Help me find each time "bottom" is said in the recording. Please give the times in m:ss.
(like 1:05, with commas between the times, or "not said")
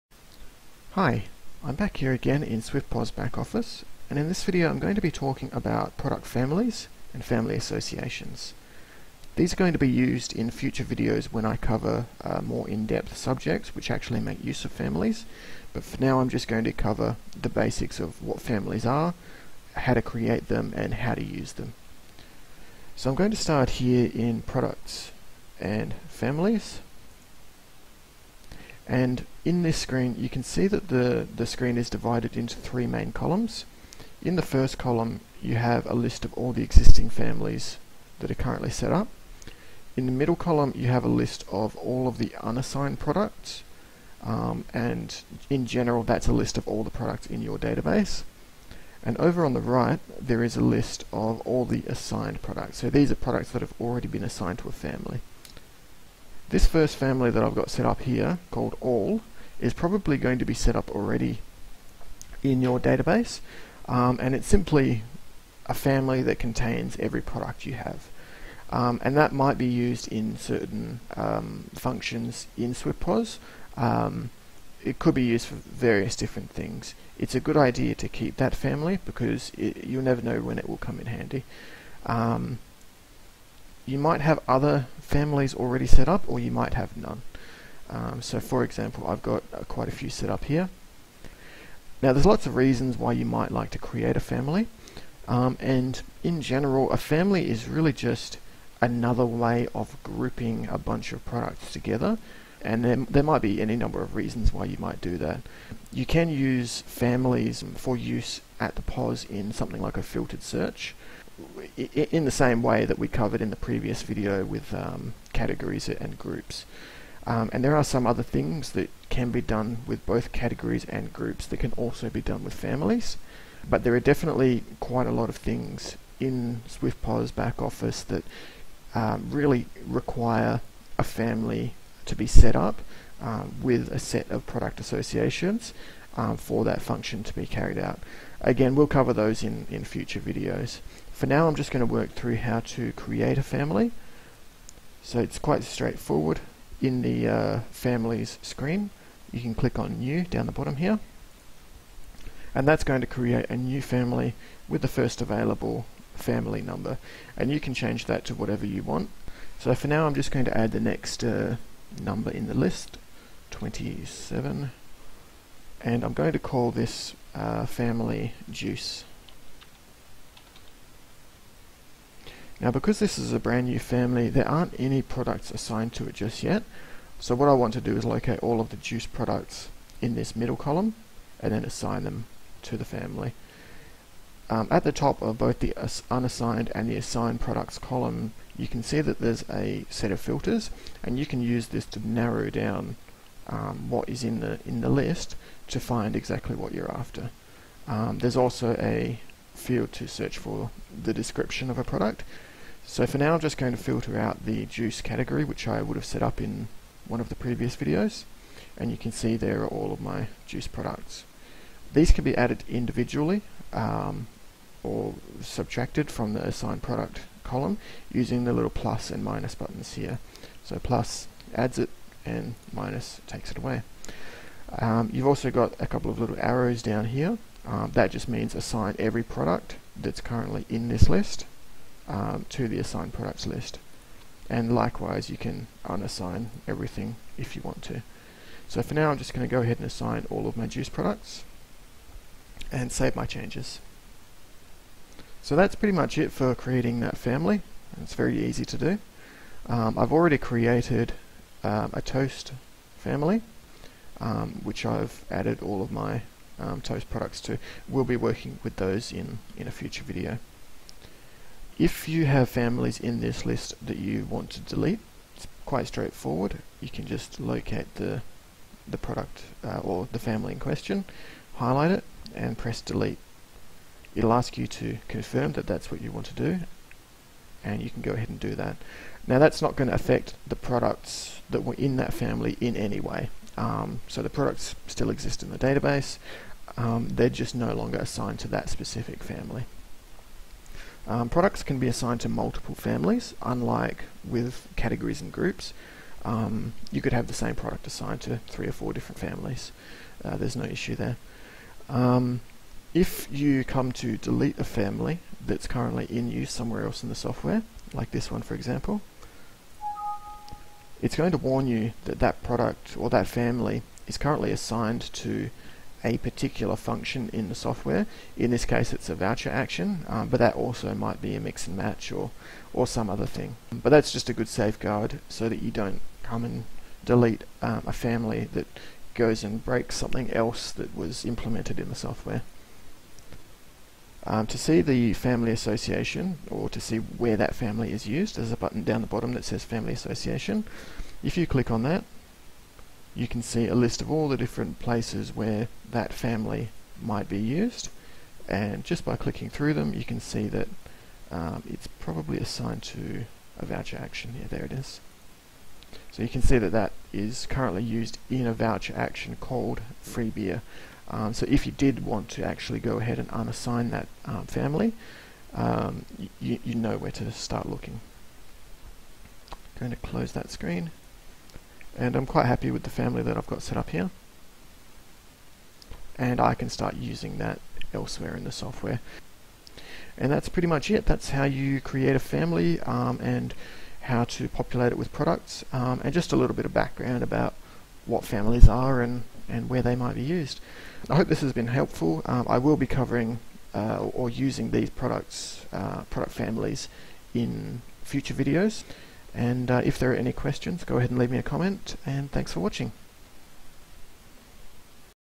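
2:30, 5:39.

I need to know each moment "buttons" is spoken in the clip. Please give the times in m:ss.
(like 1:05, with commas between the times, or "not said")
3:39, 5:38.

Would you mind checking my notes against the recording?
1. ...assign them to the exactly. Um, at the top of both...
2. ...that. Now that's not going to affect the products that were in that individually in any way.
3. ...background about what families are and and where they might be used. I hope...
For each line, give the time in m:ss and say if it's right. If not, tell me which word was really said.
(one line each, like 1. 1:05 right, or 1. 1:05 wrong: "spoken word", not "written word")
1. 3:01 wrong: "family", not "exactly"
2. 4:38 wrong: "family", not "individually"
3. 6:26 right.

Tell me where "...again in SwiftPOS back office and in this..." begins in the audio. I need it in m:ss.
0:02.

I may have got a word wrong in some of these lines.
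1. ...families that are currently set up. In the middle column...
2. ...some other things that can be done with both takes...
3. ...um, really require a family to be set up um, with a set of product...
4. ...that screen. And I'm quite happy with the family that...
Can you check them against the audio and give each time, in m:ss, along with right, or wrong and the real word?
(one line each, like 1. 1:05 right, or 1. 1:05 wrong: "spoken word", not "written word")
1. 0:37 right
2. 1:57 wrong: "categories", not "takes"
3. 2:08 right
4. 6:10 right.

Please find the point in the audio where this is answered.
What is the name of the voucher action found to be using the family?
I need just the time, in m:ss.
6:00.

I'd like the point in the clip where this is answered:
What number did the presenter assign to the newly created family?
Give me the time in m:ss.
2:43.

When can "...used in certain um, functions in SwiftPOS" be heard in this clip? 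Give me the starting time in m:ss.
1:09.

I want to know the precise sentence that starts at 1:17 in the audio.
It's a good idea to keep that family because it, you'll never know when it will come in handy.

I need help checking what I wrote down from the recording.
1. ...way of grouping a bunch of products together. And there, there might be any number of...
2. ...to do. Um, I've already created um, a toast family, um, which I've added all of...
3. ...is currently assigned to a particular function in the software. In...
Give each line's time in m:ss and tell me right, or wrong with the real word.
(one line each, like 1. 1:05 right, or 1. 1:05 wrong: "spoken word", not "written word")
1. 1:39 right
2. 4:08 right
3. 5:14 right.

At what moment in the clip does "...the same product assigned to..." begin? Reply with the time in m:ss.
4:57.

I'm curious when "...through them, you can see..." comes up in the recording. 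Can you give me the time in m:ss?
5:49.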